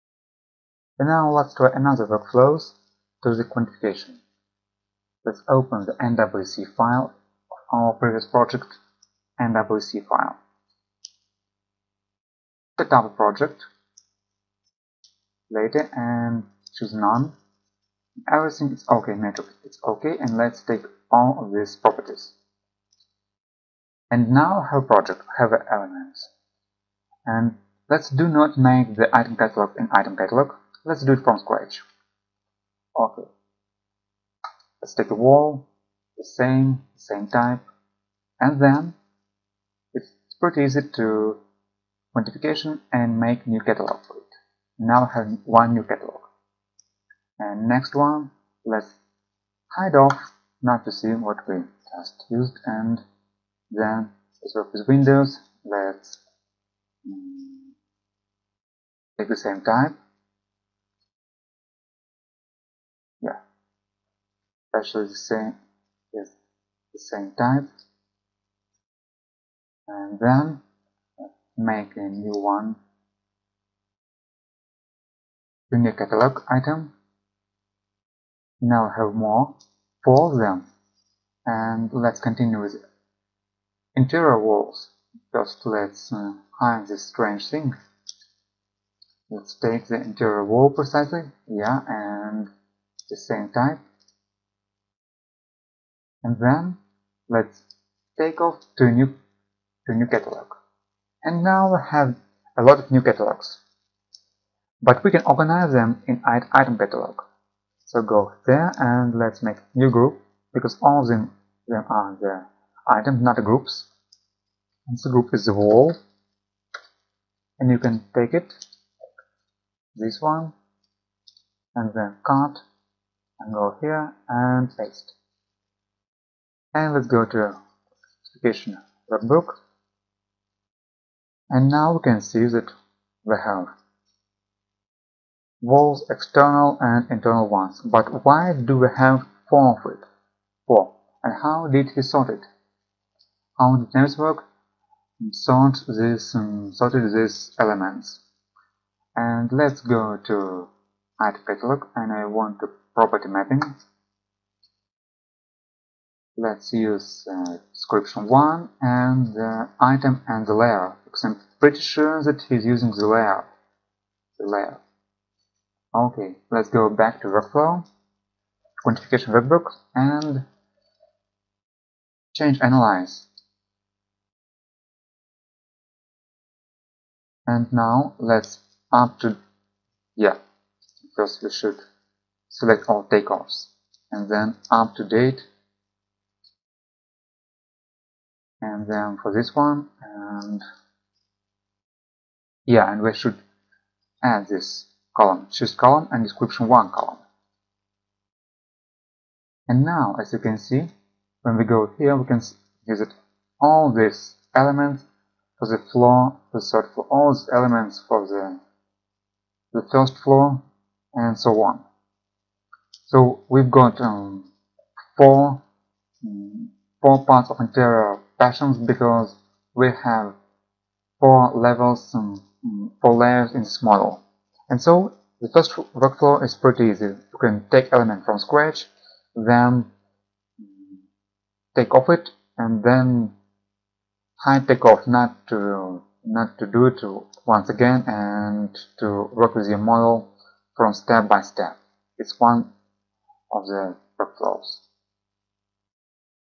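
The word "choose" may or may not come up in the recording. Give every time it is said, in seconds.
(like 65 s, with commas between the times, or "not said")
16 s, 195 s.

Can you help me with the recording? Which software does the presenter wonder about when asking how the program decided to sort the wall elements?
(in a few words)
Navisworks.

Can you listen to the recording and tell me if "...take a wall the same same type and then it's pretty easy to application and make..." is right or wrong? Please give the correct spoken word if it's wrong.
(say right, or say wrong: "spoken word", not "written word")
wrong: "modification", not "application".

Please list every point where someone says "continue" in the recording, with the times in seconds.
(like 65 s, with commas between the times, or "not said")
82 s.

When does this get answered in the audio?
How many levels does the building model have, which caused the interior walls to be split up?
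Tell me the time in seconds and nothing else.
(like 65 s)
221 s.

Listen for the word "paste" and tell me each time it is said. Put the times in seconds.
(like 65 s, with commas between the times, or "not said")
124 s.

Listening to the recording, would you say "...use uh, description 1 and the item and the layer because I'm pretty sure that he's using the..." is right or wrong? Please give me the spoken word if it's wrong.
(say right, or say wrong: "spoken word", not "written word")
right.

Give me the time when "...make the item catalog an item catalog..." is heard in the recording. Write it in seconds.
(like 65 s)
28 s.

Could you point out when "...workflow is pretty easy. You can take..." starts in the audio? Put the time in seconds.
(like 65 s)
225 s.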